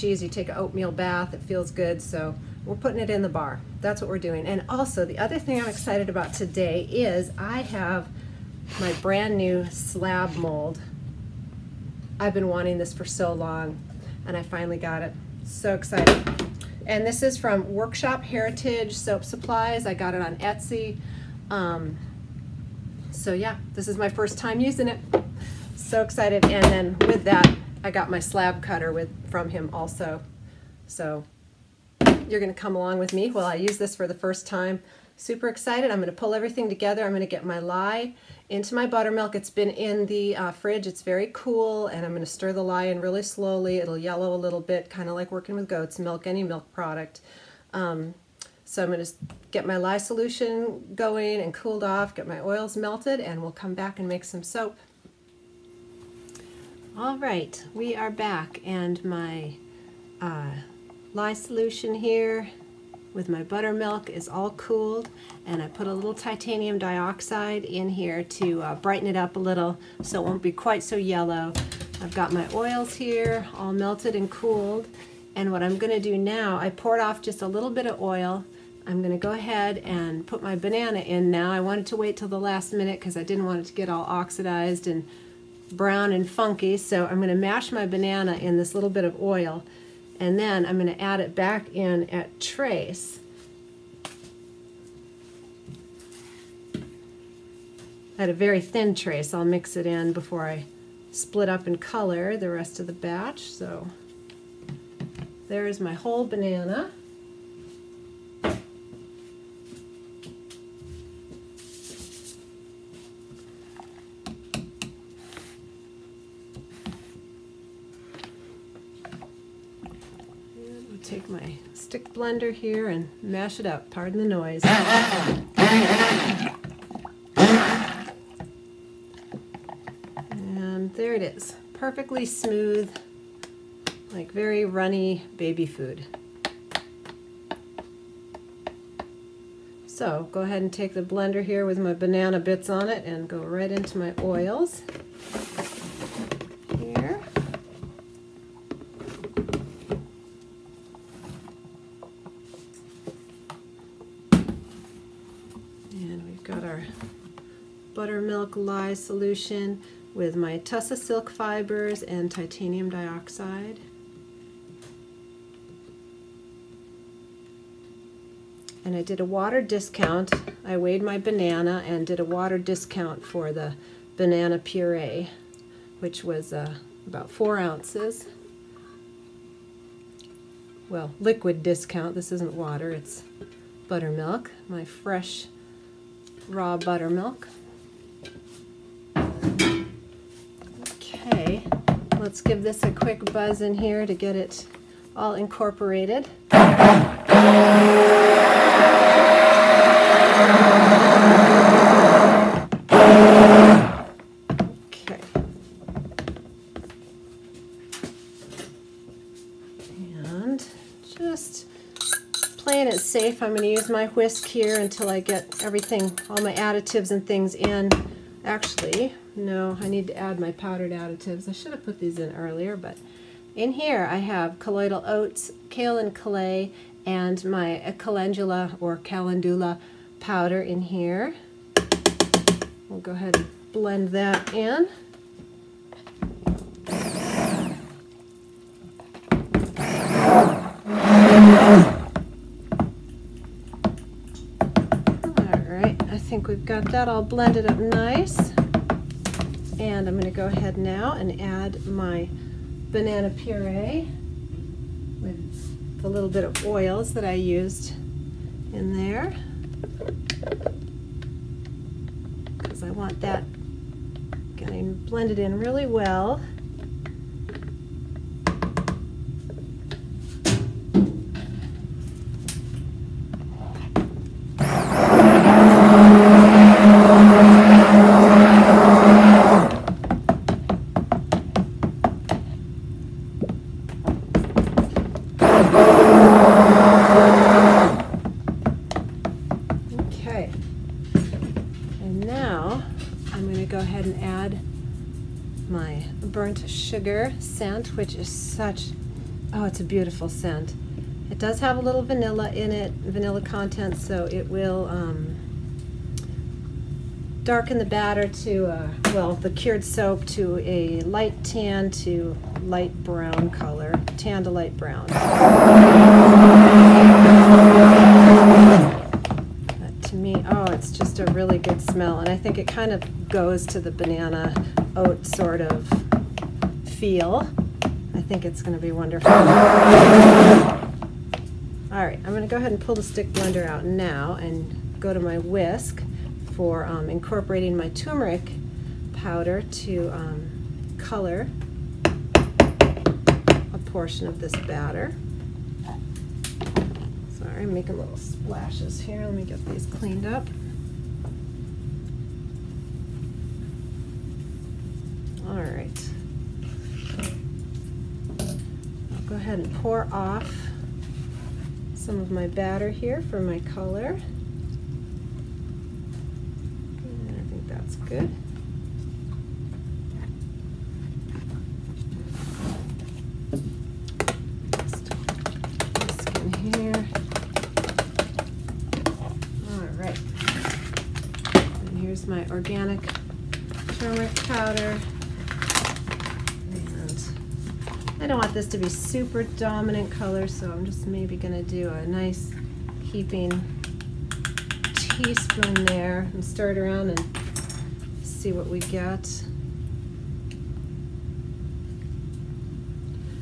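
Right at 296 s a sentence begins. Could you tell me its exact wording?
sugar scent, which is such, oh, it's a beautiful scent.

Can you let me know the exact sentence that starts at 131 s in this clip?
Perfectly smooth, like very runny baby food.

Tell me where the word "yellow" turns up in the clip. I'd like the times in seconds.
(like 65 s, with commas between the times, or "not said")
43 s, 70 s.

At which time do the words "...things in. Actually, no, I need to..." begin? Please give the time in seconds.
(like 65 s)
217 s.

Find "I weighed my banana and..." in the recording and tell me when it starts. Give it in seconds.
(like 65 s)
170 s.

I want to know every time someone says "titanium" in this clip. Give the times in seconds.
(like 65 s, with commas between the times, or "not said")
66 s, 162 s.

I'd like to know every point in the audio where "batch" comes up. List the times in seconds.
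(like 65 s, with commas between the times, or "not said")
102 s.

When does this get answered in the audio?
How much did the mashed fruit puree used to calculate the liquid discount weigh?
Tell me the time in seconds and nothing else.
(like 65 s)
177 s.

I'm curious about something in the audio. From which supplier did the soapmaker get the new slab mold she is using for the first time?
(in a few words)
Workshop Heritage Soap Supplies.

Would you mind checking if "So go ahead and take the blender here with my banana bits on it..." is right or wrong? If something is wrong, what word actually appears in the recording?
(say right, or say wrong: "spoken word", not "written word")
right.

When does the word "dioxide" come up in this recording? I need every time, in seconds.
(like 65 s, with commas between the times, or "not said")
66 s, 162 s.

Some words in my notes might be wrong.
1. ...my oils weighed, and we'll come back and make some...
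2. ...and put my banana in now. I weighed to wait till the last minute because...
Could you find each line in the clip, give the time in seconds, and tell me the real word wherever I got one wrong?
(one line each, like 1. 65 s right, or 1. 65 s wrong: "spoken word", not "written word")
1. 52 s wrong: "melted", not "weighed"
2. 79 s wrong: "wanted", not "weighed".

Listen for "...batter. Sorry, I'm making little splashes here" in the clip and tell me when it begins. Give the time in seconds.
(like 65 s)
344 s.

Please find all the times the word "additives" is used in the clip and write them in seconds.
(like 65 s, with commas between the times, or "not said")
216 s, 220 s.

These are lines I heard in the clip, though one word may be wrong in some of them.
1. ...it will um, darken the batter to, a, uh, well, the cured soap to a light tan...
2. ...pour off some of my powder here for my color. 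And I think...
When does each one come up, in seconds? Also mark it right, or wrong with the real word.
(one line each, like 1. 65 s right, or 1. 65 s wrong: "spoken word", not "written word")
1. 304 s right
2. 359 s wrong: "batter", not "powder".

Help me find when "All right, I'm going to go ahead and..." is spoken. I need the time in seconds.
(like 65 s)
329 s.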